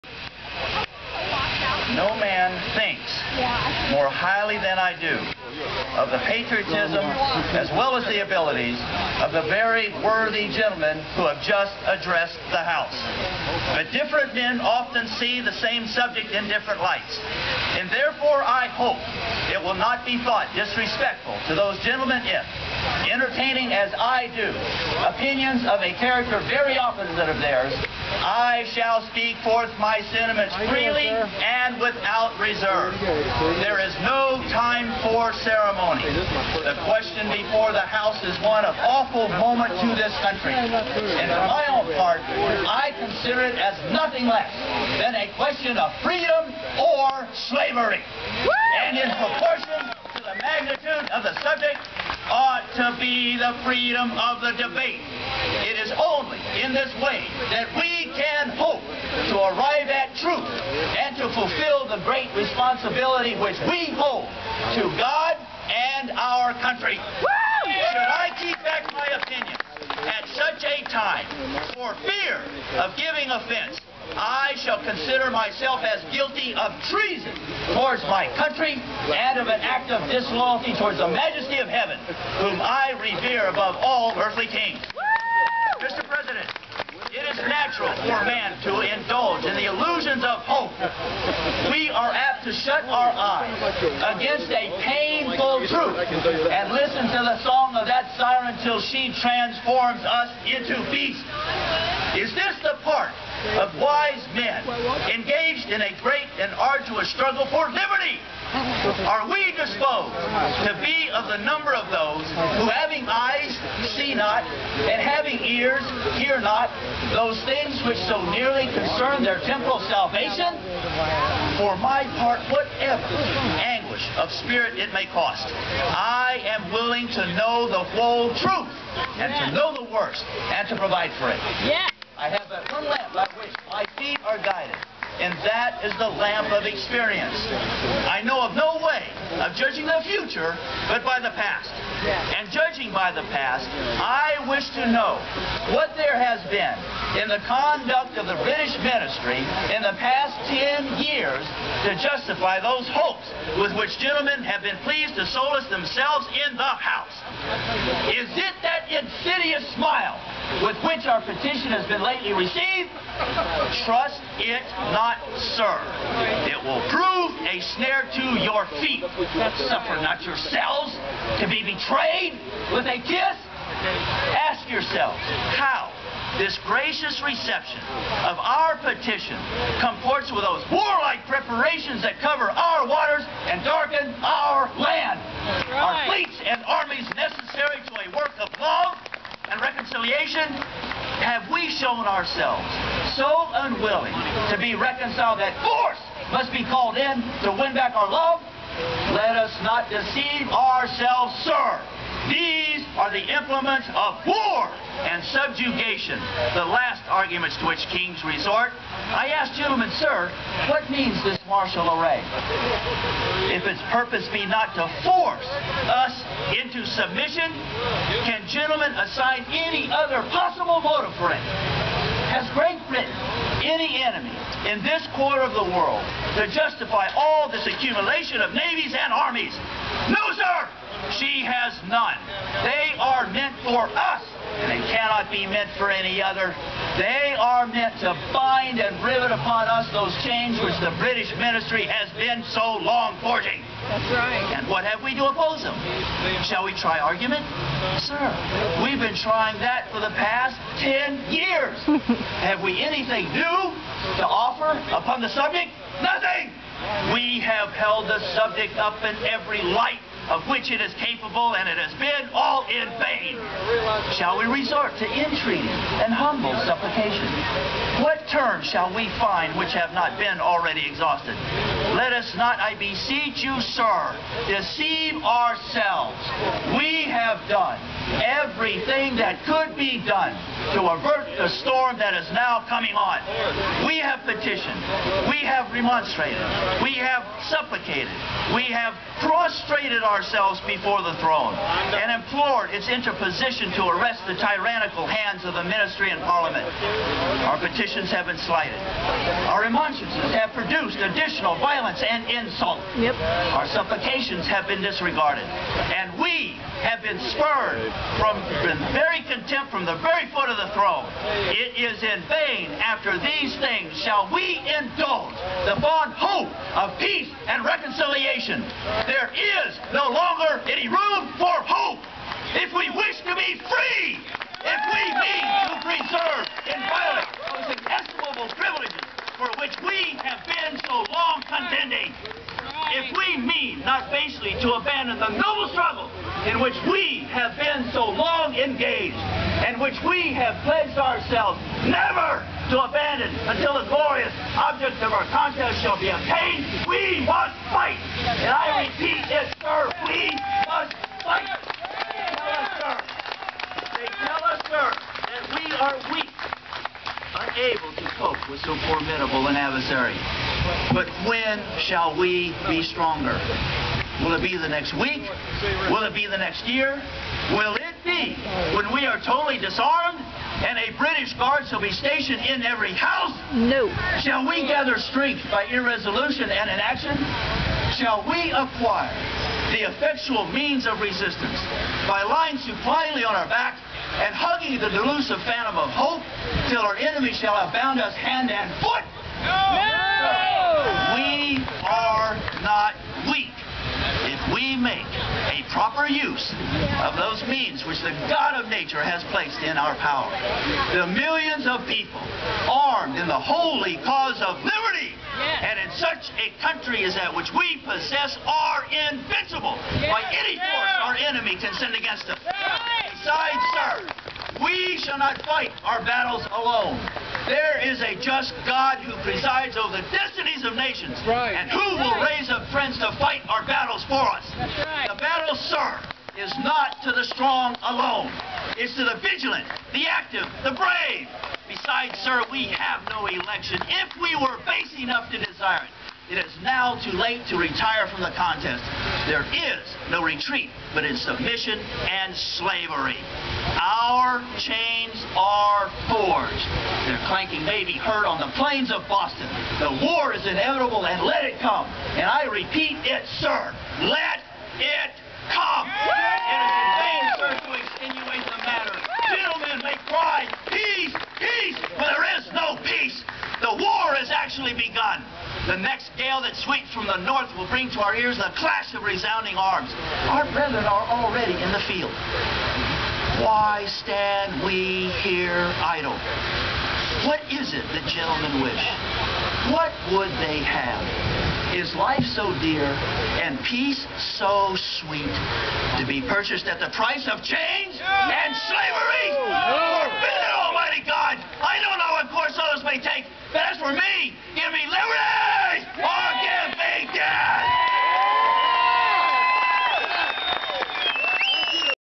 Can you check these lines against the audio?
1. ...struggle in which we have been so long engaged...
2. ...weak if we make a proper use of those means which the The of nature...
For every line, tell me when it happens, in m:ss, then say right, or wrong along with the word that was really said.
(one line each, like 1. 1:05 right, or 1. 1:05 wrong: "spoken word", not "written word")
1. 5:35 right
2. 6:33 wrong: "God", not "The".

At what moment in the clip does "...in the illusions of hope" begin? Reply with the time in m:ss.
1:29.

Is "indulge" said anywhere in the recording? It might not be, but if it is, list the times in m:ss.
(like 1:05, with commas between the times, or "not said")
1:28, 5:14.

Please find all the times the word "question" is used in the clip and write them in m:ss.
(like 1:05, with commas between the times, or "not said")
0:36, 0:45.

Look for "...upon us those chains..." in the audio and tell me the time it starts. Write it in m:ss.
3:59.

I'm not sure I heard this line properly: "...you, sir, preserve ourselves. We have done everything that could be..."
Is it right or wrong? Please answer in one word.
wrong.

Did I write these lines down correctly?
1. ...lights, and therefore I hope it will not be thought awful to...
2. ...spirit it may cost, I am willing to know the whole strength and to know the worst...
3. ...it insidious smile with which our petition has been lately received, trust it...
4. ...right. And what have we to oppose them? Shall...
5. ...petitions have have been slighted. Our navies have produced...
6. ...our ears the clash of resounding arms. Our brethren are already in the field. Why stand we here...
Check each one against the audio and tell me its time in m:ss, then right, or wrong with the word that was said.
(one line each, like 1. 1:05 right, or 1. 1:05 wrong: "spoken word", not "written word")
1. 0:16 wrong: "disrespectful", not "awful"
2. 2:04 wrong: "truth", not "strength"
3. 2:38 right
4. 4:04 right
5. 4:57 wrong: "remonstrances", not "navies"
6. 7:48 right.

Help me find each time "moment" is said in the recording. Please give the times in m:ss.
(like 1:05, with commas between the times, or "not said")
0:39.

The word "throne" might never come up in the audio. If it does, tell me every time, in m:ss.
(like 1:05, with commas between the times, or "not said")
4:51, 5:10.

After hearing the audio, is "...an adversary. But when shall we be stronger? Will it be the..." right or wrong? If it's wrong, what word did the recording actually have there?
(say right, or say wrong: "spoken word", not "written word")
right.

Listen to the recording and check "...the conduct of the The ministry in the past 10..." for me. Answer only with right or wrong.
wrong.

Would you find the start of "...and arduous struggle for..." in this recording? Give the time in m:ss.
1:46.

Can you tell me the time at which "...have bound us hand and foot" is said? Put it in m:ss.
6:27.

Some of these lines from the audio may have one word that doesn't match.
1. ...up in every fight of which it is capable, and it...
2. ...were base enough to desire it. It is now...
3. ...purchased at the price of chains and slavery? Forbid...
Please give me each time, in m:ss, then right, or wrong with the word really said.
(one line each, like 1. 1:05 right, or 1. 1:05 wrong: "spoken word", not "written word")
1. 4:18 wrong: "light", not "fight"
2. 7:14 right
3. 8:06 right.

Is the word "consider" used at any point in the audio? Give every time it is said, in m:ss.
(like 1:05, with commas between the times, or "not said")
0:42, 1:14.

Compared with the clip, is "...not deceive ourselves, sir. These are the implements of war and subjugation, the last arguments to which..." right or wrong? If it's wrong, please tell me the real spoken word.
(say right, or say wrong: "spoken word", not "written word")
right.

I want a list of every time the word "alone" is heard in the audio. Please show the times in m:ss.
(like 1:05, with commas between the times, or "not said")
6:56, 7:07.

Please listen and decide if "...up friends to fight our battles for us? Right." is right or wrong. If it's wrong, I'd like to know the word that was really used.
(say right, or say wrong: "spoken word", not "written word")
right.